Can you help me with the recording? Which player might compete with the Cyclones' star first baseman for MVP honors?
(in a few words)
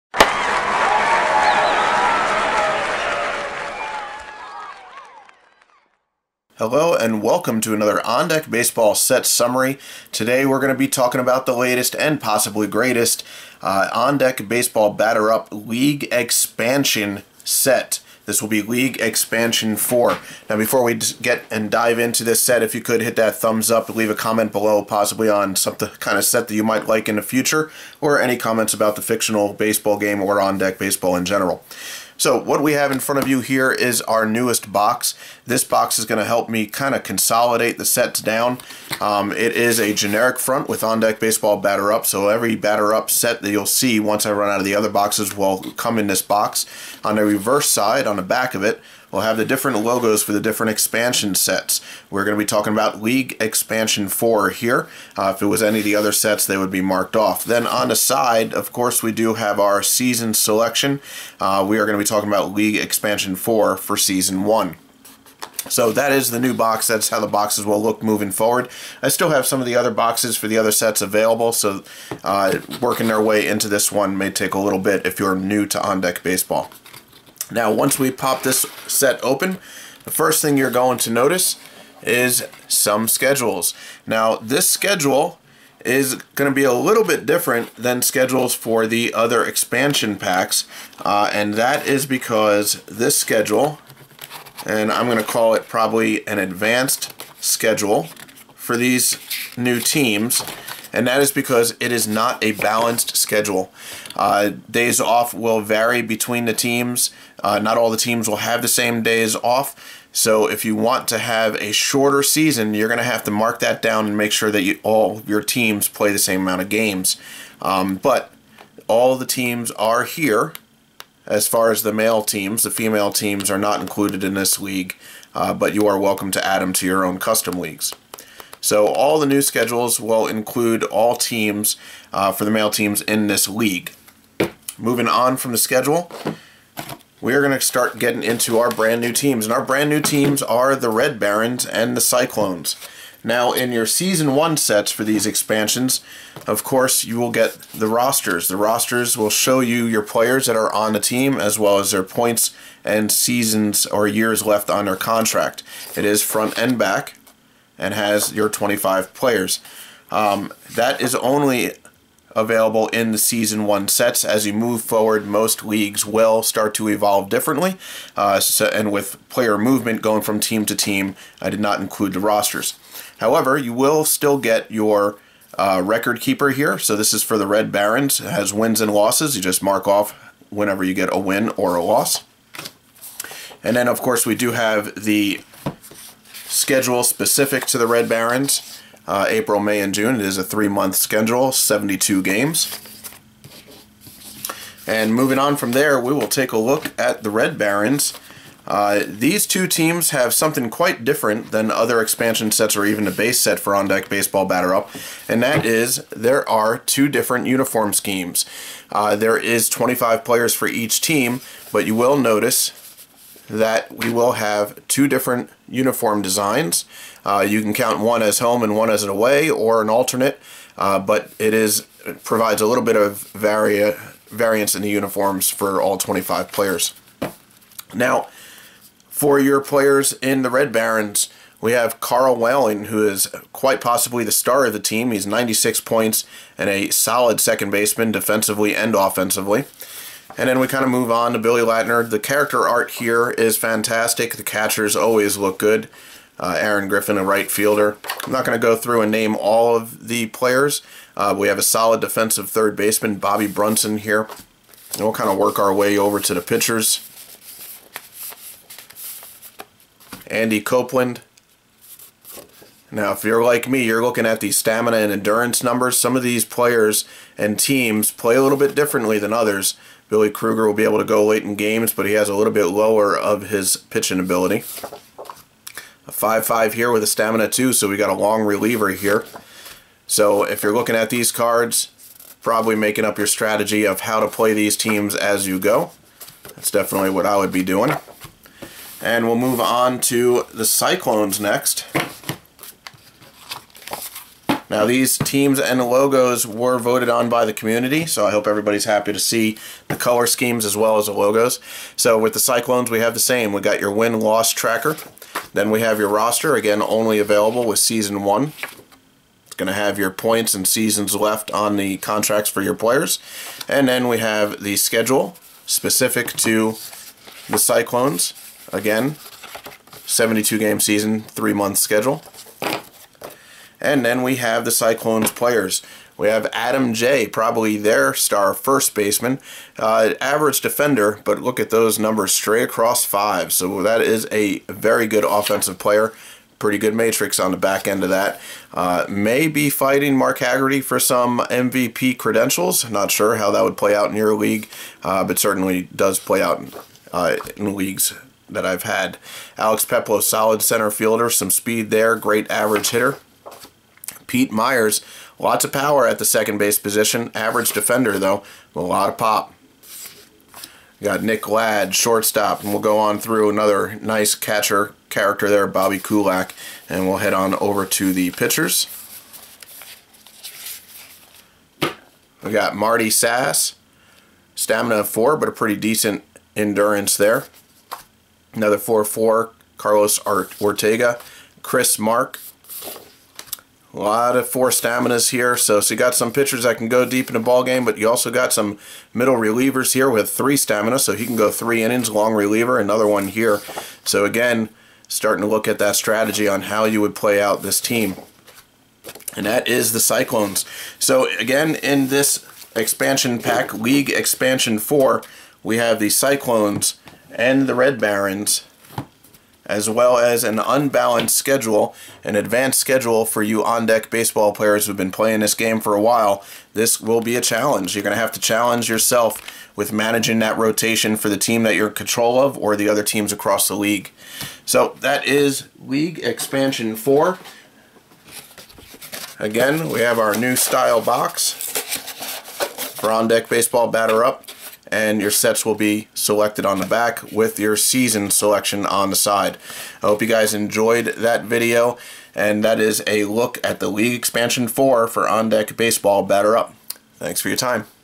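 Mark Haggerty.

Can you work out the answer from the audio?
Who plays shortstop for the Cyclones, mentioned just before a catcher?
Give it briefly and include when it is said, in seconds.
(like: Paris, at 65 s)
Nick Ladd, at 361 s.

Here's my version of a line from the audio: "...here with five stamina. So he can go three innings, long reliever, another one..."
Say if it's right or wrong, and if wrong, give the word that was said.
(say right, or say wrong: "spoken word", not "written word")
wrong: "three", not "five".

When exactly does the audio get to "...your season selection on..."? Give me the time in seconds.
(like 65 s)
437 s.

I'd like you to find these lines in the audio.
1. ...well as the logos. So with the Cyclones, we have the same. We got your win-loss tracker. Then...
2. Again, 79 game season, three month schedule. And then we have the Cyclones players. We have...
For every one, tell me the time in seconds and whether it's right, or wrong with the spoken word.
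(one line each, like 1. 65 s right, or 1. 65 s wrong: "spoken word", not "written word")
1. 300 s right
2. 318 s wrong: "72", not "79".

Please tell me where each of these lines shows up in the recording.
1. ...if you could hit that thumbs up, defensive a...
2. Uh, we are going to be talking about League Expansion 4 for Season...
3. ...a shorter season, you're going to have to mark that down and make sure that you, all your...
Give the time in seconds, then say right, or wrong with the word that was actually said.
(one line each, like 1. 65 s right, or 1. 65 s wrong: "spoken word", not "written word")
1. 22 s wrong: "leave", not "defensive"
2. 61 s right
3. 111 s right.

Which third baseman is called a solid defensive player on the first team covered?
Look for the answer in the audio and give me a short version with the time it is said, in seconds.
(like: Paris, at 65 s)
Bobby Brunson, at 253 s.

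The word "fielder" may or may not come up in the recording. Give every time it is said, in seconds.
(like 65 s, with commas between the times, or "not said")
247 s, 350 s.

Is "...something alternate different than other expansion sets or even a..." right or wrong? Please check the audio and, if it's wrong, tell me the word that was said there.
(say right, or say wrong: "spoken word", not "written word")
wrong: "quite", not "alternate".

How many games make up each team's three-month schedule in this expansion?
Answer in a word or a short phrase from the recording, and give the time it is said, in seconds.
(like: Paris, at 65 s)
72, at 191 s.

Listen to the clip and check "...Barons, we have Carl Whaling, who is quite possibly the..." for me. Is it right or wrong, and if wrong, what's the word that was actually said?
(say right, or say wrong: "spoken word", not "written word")
right.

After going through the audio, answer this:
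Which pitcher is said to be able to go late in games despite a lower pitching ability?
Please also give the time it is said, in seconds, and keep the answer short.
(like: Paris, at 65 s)
Billy Kruger, at 270 s.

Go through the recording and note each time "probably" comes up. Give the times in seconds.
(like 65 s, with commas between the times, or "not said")
95 s, 282 s, 327 s.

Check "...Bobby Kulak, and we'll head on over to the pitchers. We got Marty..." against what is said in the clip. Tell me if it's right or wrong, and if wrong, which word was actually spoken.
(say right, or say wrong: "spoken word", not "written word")
right.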